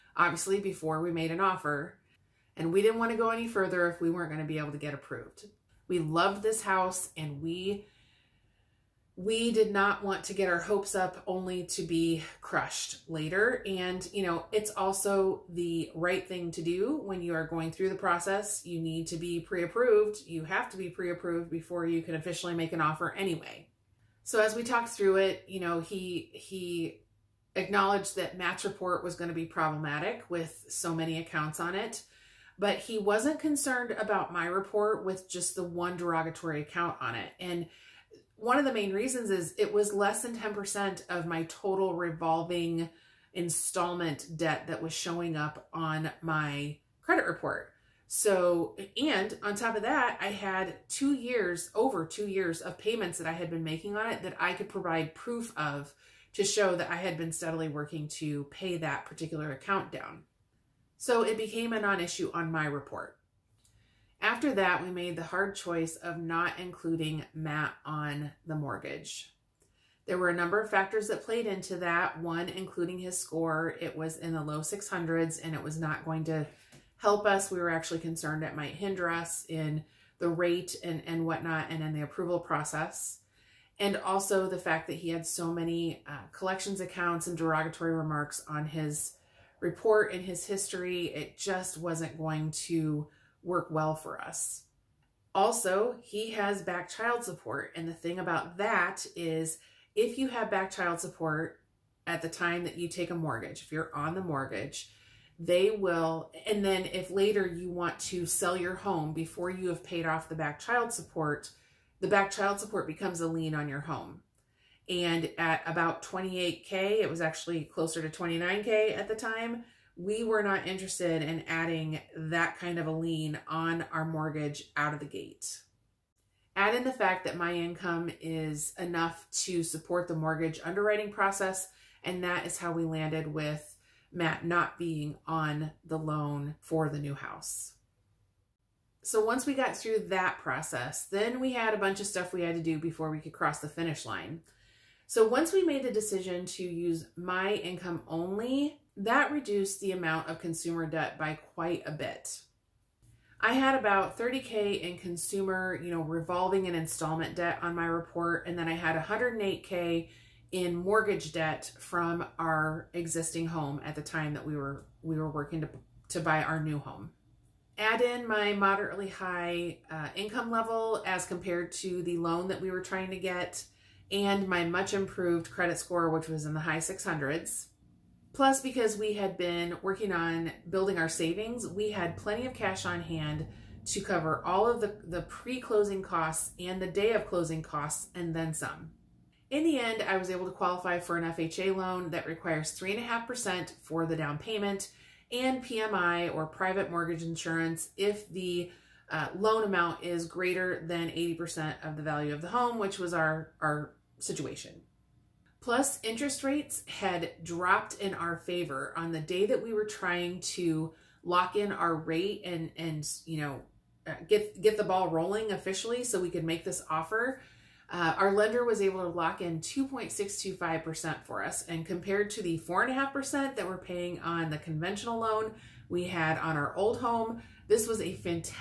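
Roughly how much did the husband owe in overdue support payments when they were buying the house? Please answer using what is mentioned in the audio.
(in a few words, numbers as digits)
29K.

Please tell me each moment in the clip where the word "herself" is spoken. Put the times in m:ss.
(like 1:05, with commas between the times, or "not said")
not said.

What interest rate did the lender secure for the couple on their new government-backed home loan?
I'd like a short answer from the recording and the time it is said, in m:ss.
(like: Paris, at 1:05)
2.625%, at 3:39.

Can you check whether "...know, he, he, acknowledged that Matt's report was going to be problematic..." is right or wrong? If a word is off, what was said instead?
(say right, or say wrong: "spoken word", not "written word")
right.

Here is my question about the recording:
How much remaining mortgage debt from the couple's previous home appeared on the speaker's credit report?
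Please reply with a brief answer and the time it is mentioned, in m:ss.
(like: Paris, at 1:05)
108k, at 2:38.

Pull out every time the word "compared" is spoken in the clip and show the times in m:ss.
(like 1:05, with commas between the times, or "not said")
2:51, 3:41.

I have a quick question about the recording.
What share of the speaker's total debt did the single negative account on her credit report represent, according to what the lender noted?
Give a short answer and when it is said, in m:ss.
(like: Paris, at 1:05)
less than 10%, at 0:39.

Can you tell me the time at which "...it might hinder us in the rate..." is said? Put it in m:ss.
1:18.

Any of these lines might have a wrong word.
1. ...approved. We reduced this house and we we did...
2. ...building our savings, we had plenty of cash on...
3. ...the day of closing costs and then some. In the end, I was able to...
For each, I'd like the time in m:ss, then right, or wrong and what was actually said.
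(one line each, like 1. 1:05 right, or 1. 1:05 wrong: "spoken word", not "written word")
1. 0:04 wrong: "loved", not "reduced"
2. 3:00 right
3. 3:06 right.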